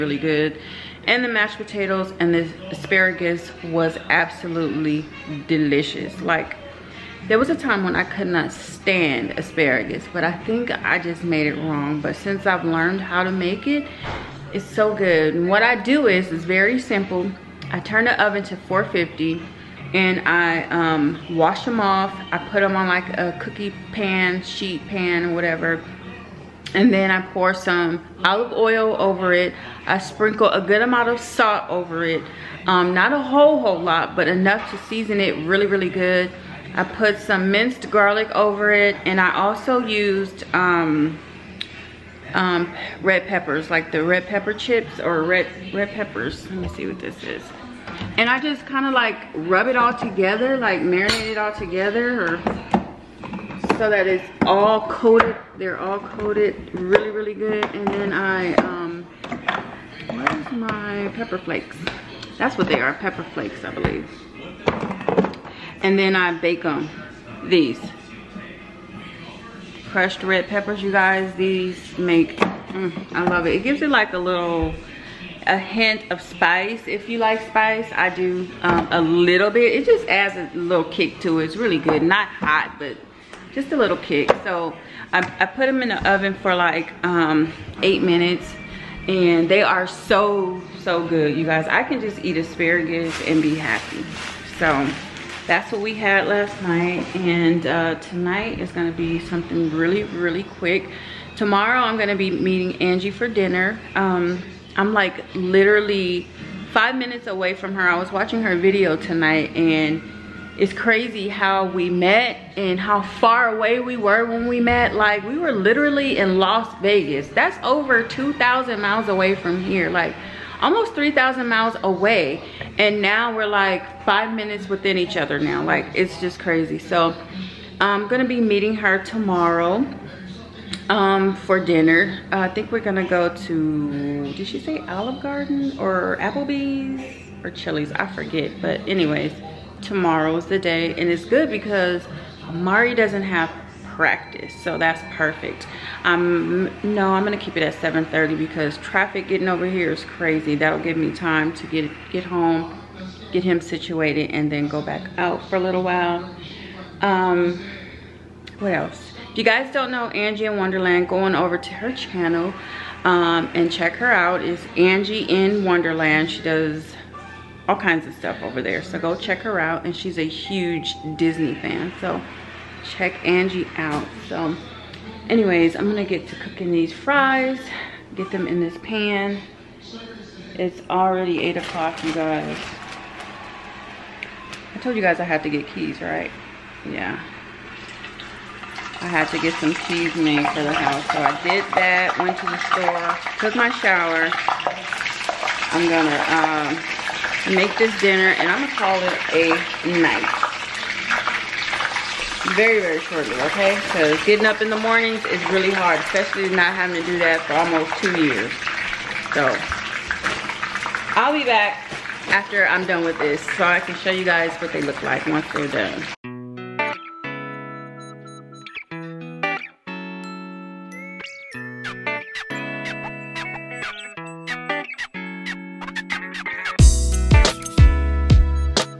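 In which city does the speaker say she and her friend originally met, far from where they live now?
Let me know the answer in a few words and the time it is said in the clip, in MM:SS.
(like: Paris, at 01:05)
Las Vegas, at 01:56.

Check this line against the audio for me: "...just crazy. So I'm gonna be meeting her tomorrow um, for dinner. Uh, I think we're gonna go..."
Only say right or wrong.
right.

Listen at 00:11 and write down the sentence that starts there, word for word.
But since I've learned how to make it, it's so good.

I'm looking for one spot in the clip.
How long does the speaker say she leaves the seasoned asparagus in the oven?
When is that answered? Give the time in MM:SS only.
01:27.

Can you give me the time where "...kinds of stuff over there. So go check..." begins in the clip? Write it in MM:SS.
02:47.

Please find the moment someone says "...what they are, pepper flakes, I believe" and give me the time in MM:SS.
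01:02.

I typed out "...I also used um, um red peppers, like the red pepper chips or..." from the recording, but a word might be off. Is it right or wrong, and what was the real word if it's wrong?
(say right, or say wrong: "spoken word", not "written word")
right.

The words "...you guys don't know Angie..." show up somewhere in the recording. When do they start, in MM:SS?
02:39.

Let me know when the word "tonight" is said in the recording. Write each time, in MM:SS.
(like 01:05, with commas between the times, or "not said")
01:37, 01:48.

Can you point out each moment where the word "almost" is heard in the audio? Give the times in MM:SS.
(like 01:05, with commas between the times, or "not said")
02:00, 03:27.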